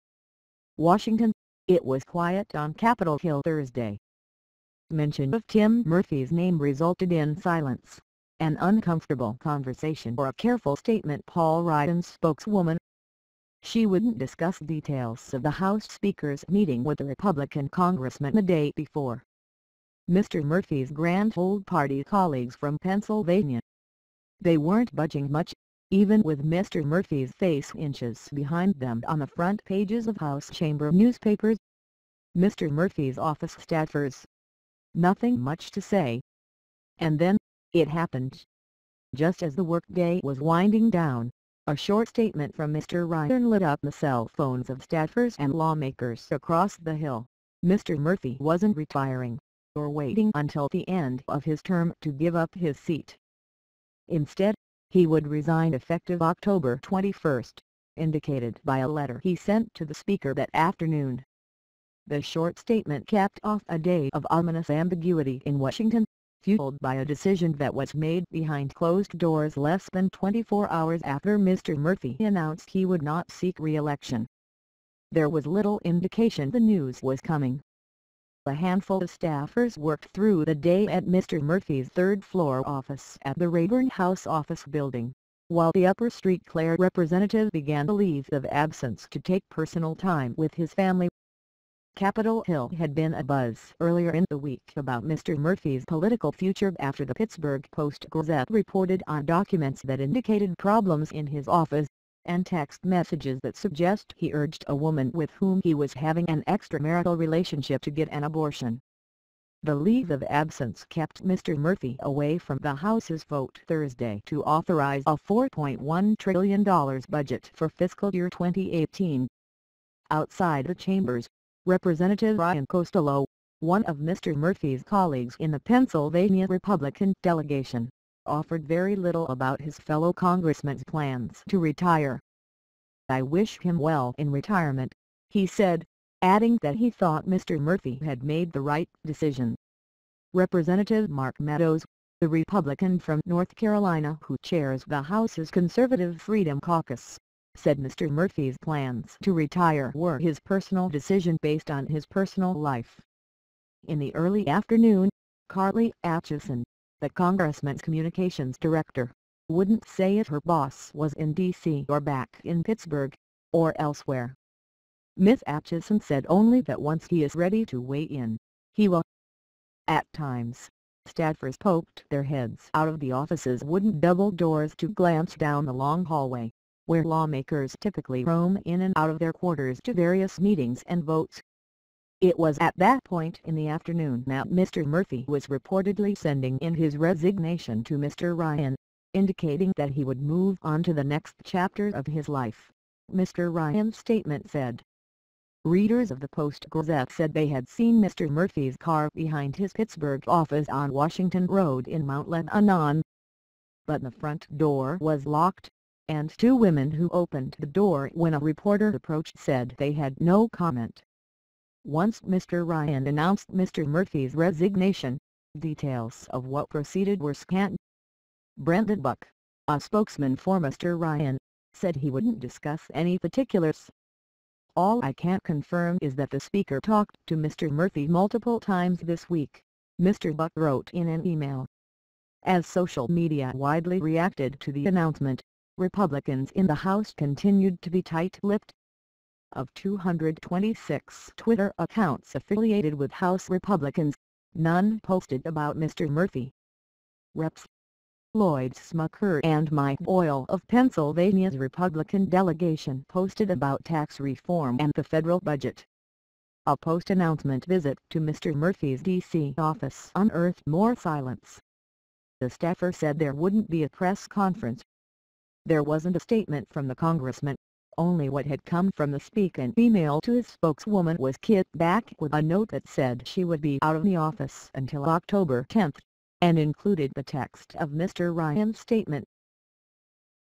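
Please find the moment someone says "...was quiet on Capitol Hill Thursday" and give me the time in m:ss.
0:01.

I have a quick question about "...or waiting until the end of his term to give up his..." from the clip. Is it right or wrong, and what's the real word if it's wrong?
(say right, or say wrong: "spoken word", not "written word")
right.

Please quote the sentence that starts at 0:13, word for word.
She wouldn't discuss details of the House Speaker's meeting with the Republican congressman the day before.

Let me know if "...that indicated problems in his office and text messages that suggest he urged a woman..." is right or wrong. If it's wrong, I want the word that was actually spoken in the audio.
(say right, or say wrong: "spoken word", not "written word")
right.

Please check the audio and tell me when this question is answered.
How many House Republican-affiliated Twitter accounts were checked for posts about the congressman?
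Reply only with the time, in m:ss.
3:59.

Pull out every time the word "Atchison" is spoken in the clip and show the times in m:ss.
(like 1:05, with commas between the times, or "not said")
2:36, 2:45.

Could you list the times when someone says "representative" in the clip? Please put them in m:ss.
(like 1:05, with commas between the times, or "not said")
1:26, 2:01, 2:20.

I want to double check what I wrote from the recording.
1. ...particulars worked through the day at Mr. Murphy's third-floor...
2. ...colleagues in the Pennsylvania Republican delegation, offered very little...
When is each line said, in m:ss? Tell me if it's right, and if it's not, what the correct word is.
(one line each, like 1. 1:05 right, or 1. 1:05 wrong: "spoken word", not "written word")
1. 1:19 wrong: "staffers", not "particulars"
2. 2:04 right.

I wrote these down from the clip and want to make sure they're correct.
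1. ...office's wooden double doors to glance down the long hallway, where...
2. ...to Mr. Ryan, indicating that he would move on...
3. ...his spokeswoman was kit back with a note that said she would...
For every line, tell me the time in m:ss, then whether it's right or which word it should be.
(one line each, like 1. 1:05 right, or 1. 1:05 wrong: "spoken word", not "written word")
1. 2:53 right
2. 3:07 right
3. 4:30 right.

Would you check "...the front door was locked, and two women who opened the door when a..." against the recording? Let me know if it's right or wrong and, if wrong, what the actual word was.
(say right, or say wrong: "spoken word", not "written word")
right.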